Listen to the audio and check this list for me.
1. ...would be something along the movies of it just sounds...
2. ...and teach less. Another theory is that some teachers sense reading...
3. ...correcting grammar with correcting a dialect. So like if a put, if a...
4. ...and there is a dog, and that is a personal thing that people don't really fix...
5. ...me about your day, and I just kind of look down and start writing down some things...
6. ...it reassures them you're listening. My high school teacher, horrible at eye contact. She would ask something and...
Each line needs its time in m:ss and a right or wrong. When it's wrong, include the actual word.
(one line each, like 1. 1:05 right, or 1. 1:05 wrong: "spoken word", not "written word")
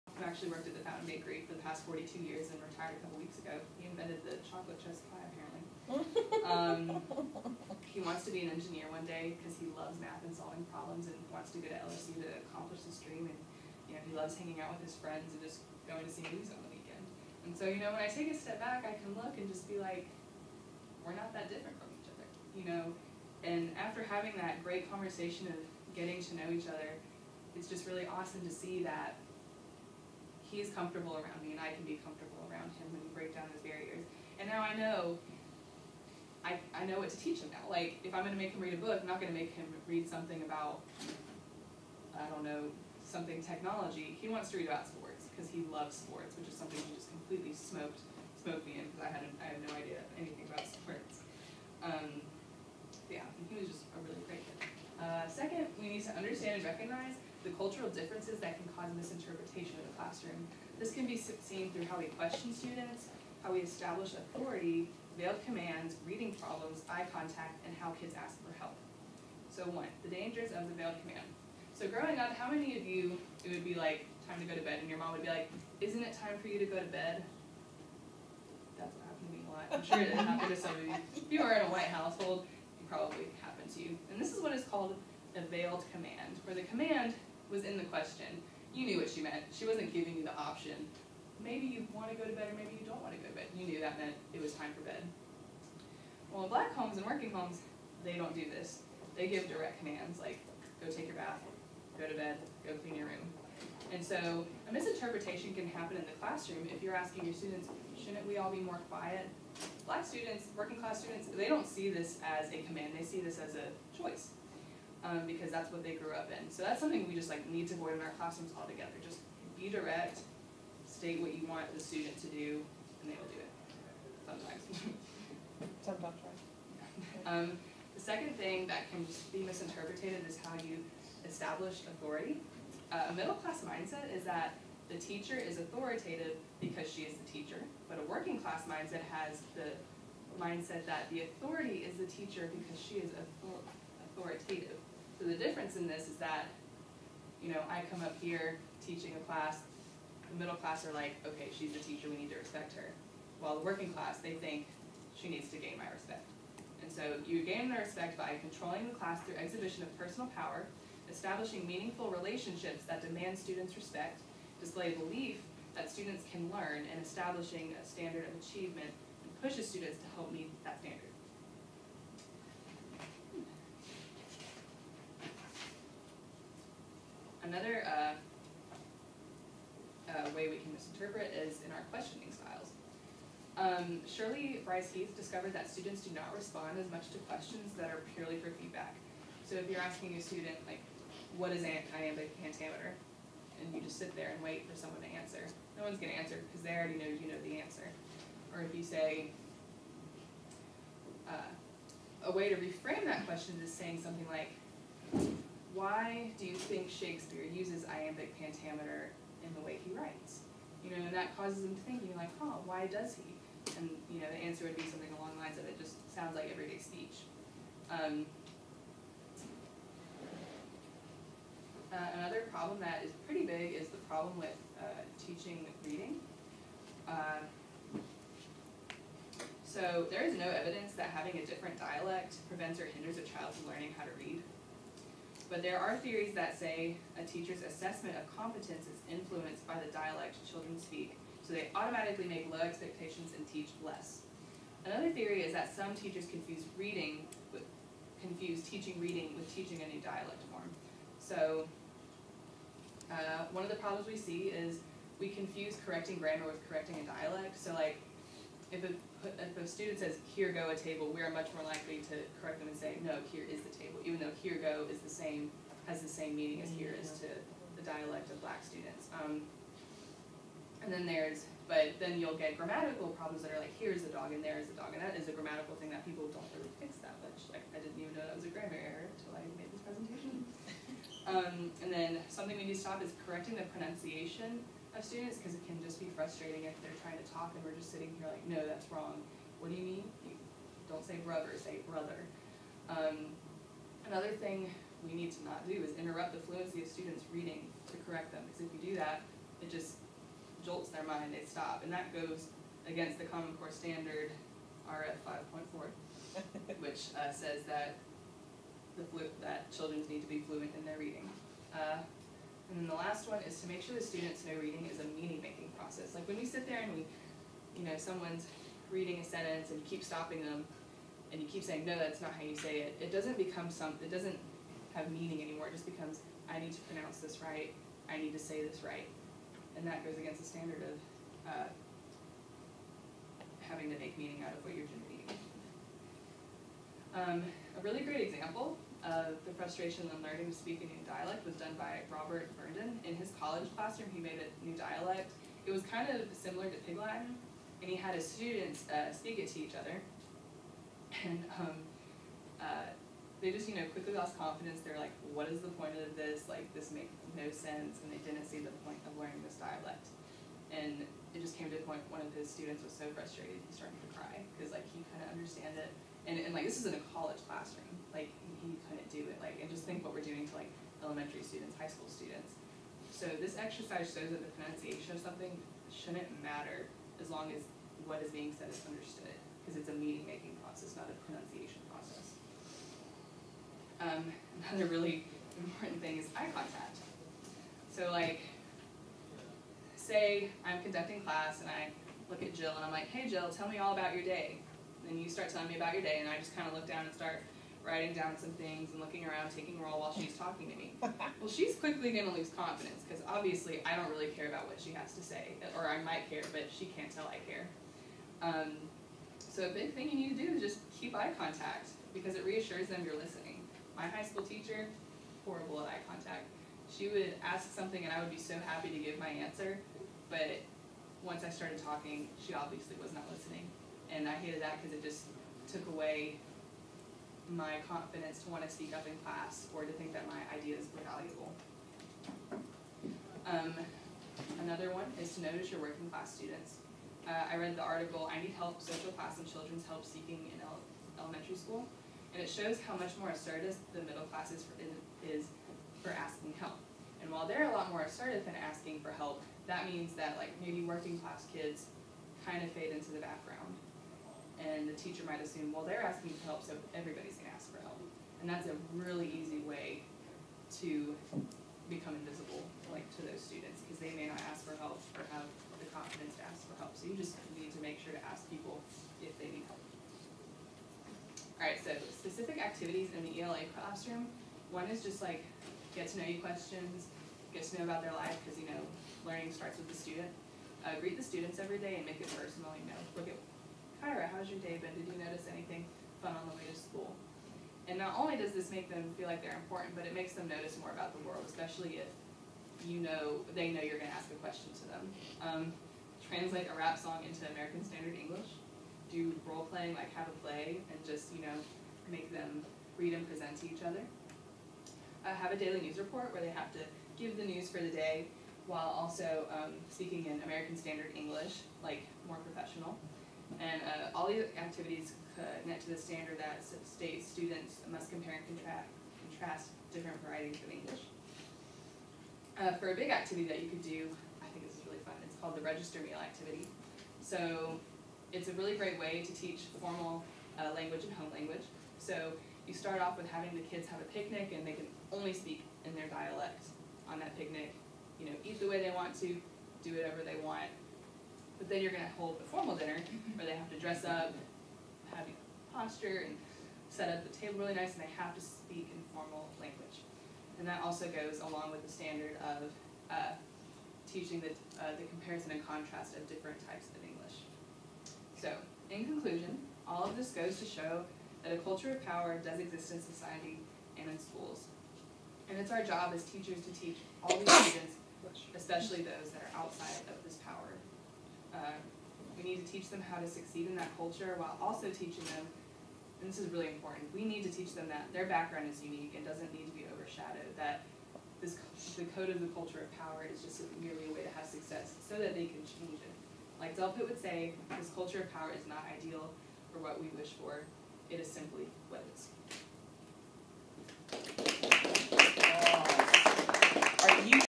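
1. 3:34 wrong: "lines", not "movies"
2. 4:03 wrong: "confuse", not "sense"
3. 4:15 right
4. 4:34 wrong: "grammatical", not "personal"
5. 6:35 right
6. 6:52 right.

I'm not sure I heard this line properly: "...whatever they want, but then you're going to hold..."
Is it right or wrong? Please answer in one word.
right.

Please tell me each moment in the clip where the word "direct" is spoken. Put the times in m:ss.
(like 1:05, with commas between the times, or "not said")
1:39, 1:59.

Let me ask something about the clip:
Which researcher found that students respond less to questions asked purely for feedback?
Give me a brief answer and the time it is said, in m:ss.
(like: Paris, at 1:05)
Shirley Bryce Heath, at 3:04.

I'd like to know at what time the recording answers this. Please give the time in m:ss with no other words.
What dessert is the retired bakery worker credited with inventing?
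0:04.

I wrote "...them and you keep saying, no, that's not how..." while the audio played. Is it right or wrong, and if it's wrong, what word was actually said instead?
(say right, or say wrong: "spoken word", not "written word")
right.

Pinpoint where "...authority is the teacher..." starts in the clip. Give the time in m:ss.
2:21.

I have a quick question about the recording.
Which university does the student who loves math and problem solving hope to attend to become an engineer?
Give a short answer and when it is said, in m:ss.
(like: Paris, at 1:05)
LSU, at 0:11.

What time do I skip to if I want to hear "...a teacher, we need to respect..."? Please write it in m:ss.
2:31.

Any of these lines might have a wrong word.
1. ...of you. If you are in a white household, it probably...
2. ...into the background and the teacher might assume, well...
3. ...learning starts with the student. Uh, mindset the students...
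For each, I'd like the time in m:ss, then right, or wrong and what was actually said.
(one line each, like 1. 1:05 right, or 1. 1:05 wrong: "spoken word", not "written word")
1. 1:20 right
2. 7:32 right
3. 7:59 wrong: "greet", not "mindset".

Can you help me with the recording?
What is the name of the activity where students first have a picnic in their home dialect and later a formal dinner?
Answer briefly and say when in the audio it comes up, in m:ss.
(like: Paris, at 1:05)
register meal activity, at 8:45.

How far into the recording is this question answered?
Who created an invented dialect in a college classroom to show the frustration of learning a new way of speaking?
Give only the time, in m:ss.
5:42.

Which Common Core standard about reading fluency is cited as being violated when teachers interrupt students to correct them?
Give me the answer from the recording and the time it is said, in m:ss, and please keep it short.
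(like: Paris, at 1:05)
RF 5.4, at 5:04.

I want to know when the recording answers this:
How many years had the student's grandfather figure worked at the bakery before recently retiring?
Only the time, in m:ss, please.
0:01.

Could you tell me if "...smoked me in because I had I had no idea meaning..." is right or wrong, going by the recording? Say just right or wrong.
wrong.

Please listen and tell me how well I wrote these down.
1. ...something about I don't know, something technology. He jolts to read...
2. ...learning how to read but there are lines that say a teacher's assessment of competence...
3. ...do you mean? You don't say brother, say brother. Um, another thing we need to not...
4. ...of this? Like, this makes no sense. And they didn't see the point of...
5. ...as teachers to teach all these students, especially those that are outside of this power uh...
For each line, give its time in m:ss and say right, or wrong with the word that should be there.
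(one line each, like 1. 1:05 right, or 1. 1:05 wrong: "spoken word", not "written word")
1. 0:40 wrong: "wants", not "jolts"
2. 3:53 wrong: "theories", not "lines"
3. 4:49 right
4. 5:55 right
5. 9:26 right.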